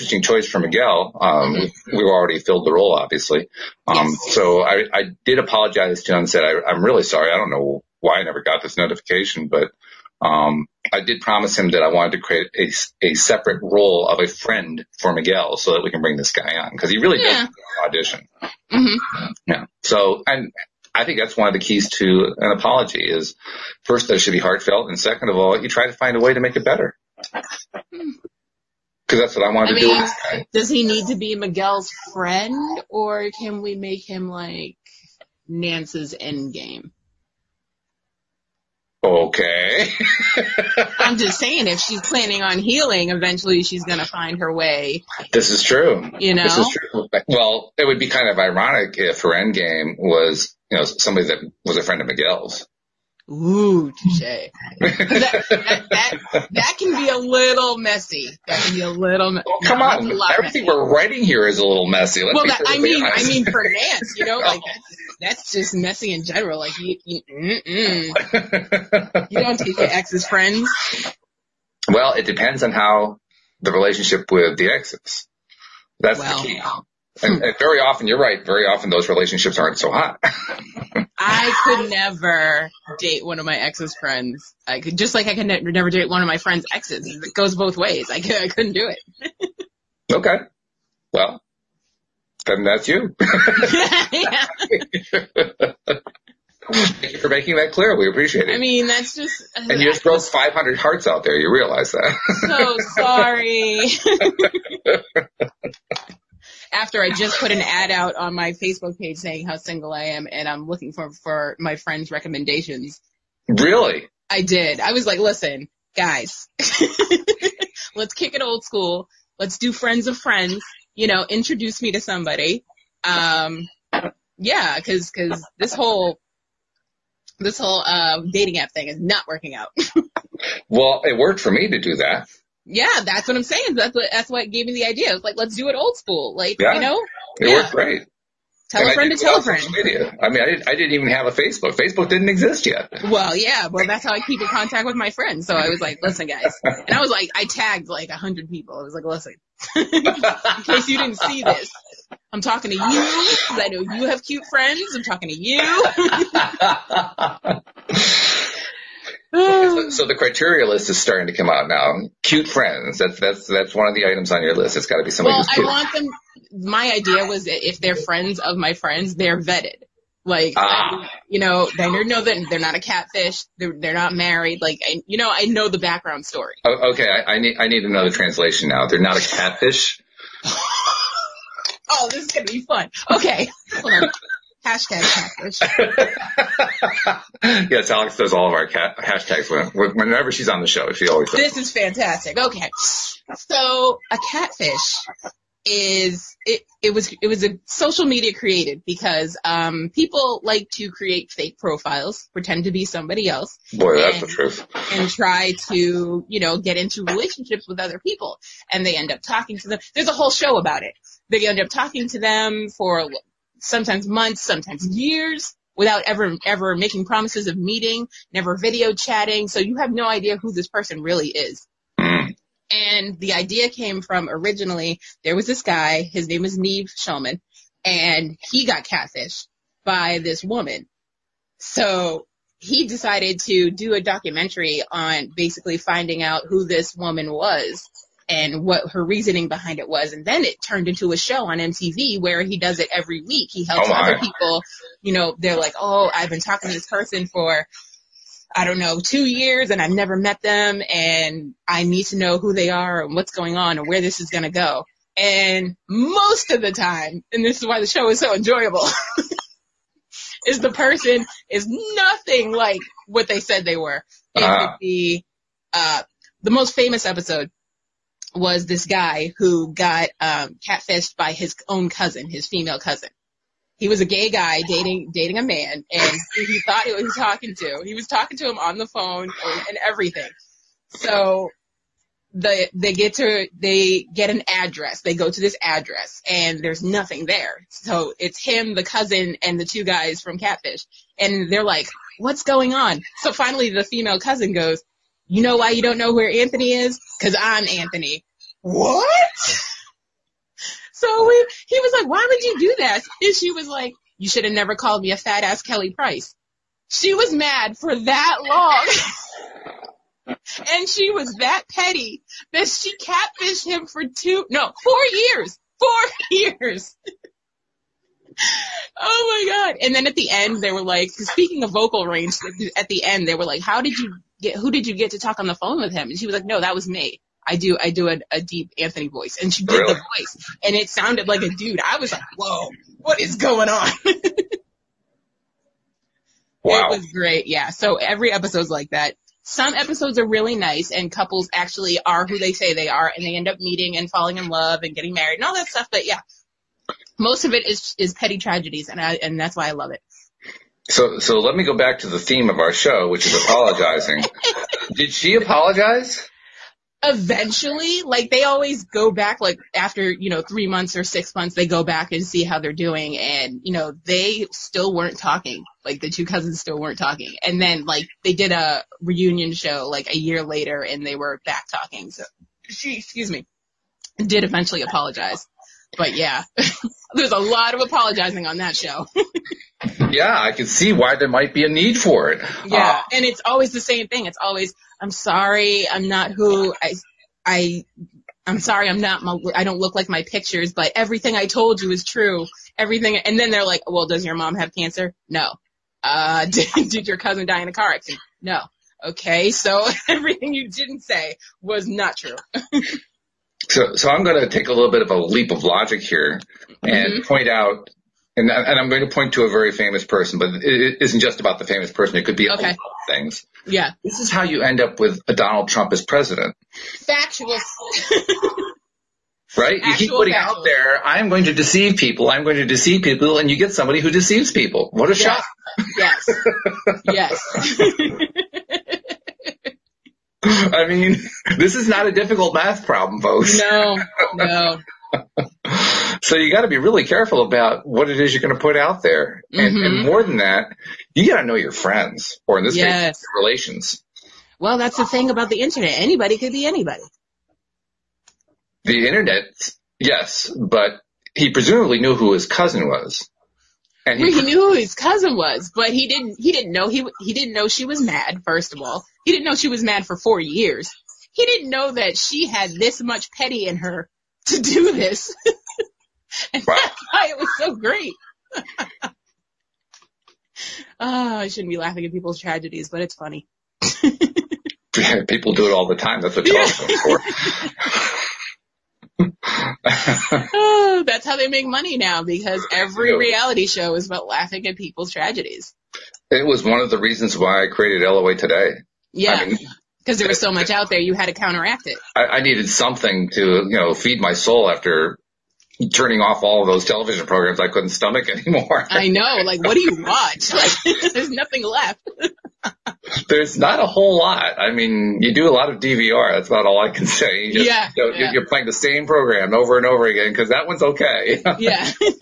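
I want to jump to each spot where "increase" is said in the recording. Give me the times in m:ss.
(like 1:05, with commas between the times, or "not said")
not said.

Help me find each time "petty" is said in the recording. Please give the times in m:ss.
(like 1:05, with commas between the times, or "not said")
5:11, 5:48, 7:43.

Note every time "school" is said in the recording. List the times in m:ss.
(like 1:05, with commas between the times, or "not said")
1:58, 2:15.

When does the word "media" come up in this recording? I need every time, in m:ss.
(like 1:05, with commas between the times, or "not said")
2:19, 3:18.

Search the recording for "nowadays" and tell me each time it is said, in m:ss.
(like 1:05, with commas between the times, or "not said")
not said.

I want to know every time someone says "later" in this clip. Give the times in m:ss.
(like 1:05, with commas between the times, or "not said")
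6:10.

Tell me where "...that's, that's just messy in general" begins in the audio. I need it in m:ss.
1:05.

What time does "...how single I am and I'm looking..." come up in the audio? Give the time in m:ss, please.
1:49.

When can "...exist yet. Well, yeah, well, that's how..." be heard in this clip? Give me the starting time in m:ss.
2:22.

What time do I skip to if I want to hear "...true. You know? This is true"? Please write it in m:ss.
0:45.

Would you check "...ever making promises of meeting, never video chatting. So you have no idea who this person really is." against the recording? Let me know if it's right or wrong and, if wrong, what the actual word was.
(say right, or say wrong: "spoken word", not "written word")
right.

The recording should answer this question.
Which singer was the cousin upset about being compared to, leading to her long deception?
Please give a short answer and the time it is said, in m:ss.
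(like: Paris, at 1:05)
Kelly Price, at 5:05.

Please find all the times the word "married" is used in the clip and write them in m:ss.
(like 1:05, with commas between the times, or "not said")
2:54, 5:45.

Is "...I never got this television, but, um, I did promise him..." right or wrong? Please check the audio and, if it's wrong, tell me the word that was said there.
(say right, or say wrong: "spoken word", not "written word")
wrong: "notification", not "television".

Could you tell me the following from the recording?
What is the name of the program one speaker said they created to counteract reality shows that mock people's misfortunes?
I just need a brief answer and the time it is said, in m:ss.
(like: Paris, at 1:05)
LOA Today, at 8:08.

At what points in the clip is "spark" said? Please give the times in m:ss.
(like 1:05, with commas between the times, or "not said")
not said.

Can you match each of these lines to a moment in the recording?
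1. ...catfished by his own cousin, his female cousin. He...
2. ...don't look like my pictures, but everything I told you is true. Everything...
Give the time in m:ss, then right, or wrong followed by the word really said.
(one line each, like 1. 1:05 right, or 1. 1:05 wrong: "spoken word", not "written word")
1. 4:30 right
2. 6:29 right.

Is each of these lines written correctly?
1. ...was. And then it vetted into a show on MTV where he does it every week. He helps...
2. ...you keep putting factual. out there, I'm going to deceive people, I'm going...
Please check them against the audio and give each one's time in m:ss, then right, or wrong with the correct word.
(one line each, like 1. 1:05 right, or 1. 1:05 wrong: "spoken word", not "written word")
1. 3:59 wrong: "turned", not "vetted"
2. 6:59 right.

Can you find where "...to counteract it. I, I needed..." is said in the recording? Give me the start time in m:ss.
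8:11.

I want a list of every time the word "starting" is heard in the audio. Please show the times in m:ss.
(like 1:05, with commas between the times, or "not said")
2:40.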